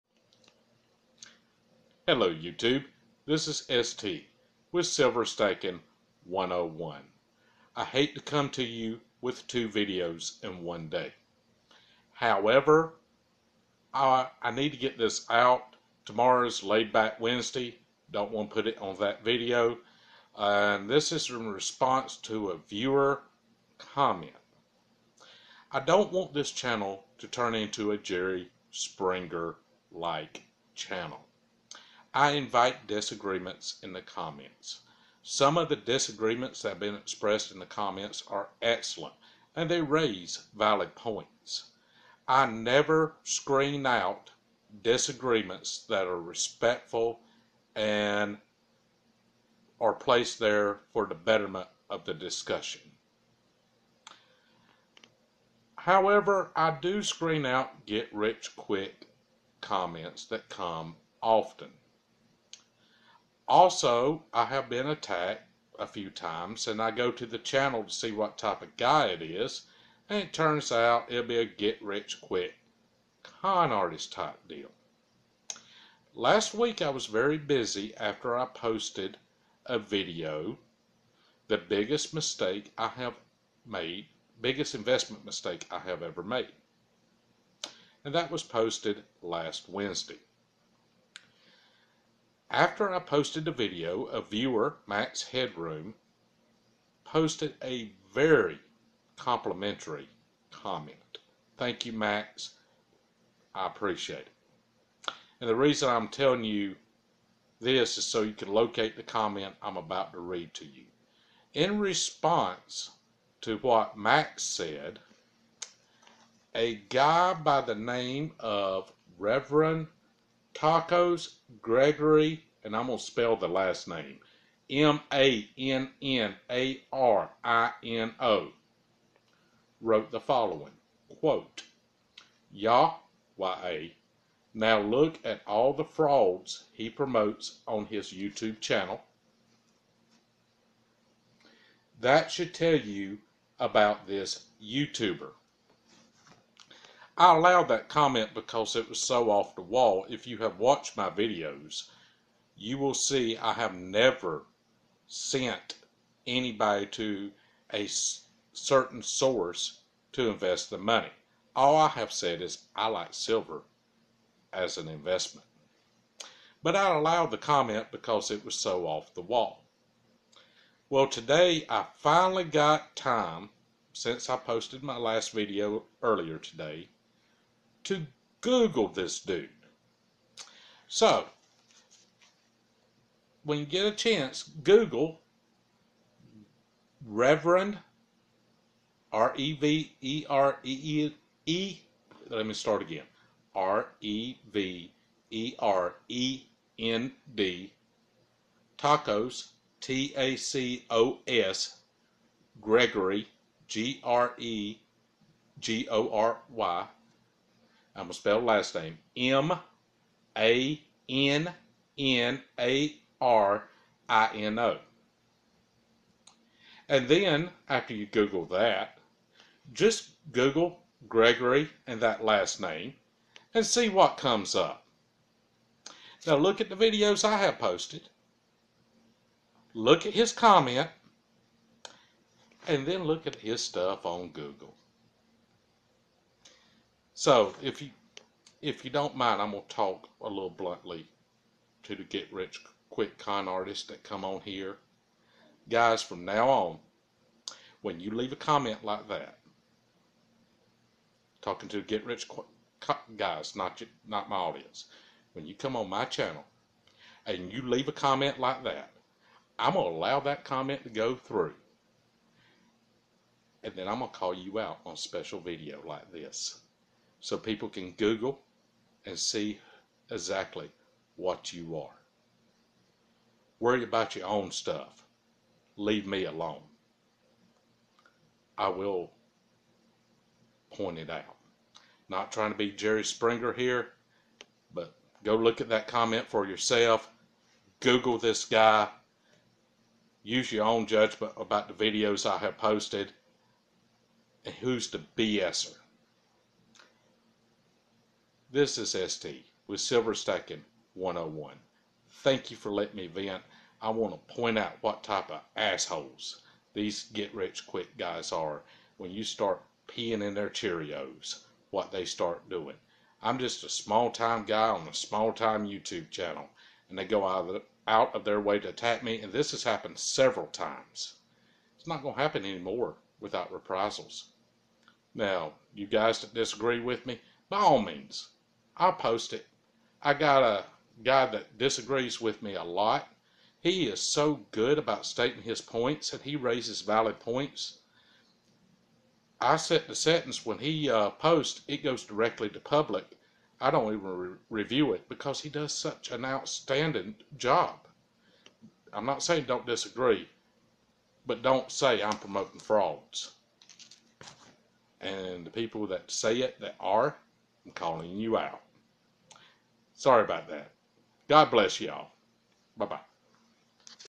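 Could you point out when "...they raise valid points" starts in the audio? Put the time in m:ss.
0:39.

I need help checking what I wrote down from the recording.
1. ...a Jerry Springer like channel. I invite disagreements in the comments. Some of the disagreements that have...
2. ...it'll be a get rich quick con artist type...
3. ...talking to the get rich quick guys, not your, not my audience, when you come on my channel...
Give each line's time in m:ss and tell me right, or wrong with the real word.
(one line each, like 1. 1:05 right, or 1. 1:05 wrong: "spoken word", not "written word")
1. 0:27 right
2. 1:11 right
3. 4:11 right.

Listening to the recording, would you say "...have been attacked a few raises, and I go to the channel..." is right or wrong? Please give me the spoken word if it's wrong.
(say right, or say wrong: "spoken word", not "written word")
wrong: "times", not "raises".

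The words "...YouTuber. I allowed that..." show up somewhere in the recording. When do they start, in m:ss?
2:24.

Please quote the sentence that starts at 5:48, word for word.
I'm not saying don't disagree, but don't say I'm promoting frauds.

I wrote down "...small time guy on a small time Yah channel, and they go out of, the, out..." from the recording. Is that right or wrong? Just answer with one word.
wrong.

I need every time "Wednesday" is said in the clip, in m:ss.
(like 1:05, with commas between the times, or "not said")
0:17, 1:29.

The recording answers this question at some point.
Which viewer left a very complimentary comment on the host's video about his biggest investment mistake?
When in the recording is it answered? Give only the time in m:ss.
1:34.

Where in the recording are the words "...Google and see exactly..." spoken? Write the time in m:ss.
4:27.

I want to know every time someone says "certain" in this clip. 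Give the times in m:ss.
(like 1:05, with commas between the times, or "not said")
2:38.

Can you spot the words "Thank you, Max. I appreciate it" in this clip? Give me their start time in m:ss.
1:41.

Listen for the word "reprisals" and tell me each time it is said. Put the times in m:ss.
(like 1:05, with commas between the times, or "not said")
5:23.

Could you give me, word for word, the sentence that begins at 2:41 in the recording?
All I have said is I like silver as an investment.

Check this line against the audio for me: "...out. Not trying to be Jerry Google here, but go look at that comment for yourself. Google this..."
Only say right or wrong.
wrong.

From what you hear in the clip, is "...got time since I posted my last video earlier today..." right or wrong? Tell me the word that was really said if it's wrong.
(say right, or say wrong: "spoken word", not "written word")
right.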